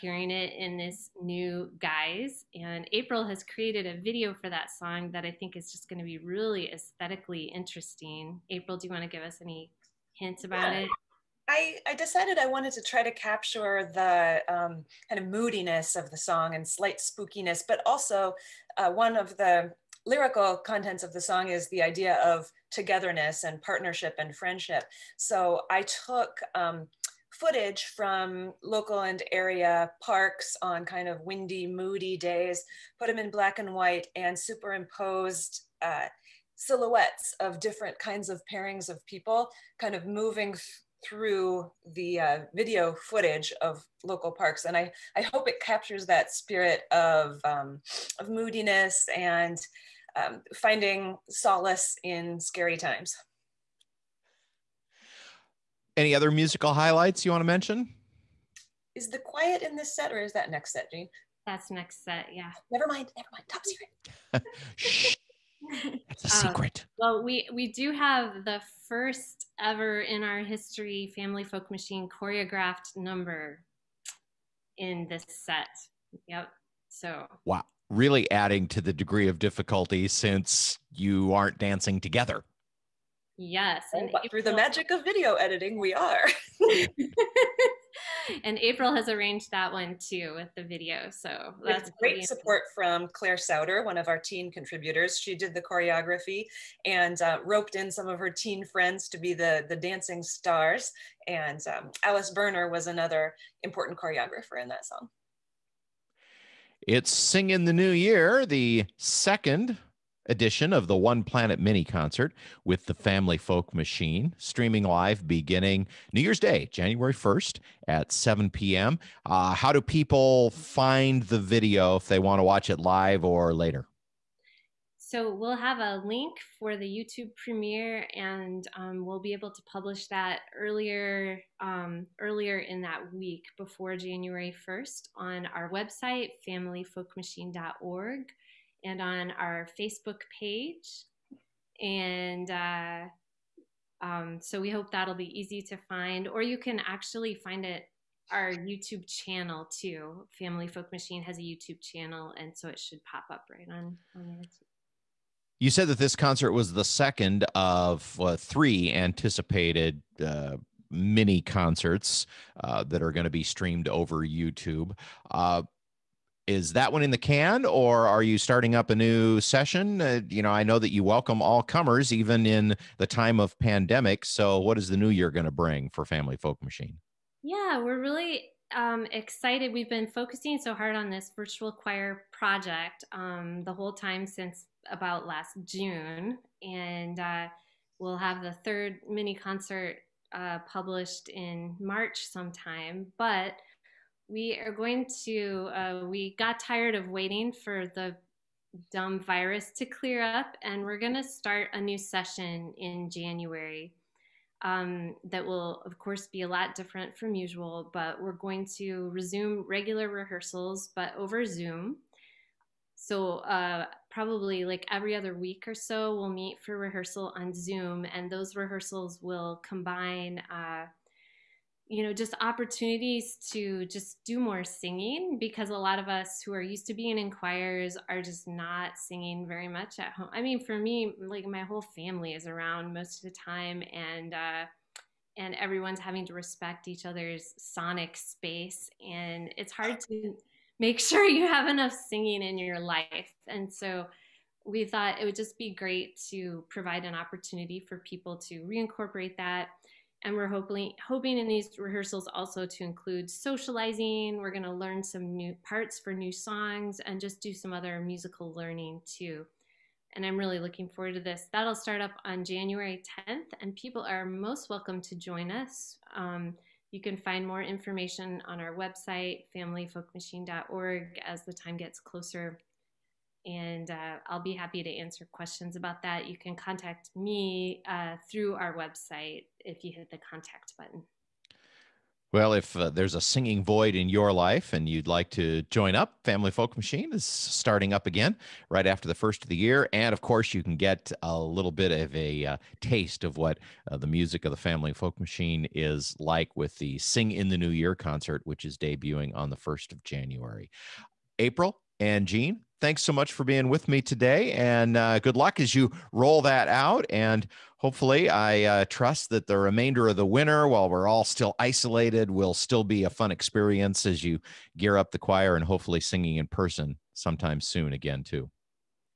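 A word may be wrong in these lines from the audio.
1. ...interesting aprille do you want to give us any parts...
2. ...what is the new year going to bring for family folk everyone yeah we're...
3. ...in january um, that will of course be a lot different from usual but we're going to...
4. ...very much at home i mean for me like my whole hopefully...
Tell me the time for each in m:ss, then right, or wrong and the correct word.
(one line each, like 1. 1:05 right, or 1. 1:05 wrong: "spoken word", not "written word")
1. 0:07 wrong: "hints", not "parts"
2. 2:54 wrong: "machine", not "everyone"
3. 3:22 right
4. 3:49 wrong: "family", not "hopefully".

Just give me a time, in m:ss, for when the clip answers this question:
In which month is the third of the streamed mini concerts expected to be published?
3:11.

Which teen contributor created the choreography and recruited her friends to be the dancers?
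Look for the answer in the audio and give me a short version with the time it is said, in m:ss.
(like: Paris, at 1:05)
Claire Souter, at 1:33.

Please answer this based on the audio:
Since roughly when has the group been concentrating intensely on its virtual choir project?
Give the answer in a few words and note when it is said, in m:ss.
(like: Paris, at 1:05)
Last June, at 3:05.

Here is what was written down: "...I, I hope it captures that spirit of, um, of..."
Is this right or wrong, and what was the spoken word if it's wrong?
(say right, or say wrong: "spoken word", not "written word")
right.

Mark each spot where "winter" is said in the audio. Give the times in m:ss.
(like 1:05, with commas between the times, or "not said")
5:10.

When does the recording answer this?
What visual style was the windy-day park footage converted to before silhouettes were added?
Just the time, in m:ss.
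0:33.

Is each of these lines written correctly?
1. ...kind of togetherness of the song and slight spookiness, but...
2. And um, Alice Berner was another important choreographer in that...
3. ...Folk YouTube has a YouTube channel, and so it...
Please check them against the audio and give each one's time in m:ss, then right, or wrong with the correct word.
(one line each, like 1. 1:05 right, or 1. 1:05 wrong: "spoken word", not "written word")
1. 0:15 wrong: "moodiness", not "togetherness"
2. 1:41 right
3. 2:30 wrong: "Machine", not "YouTube".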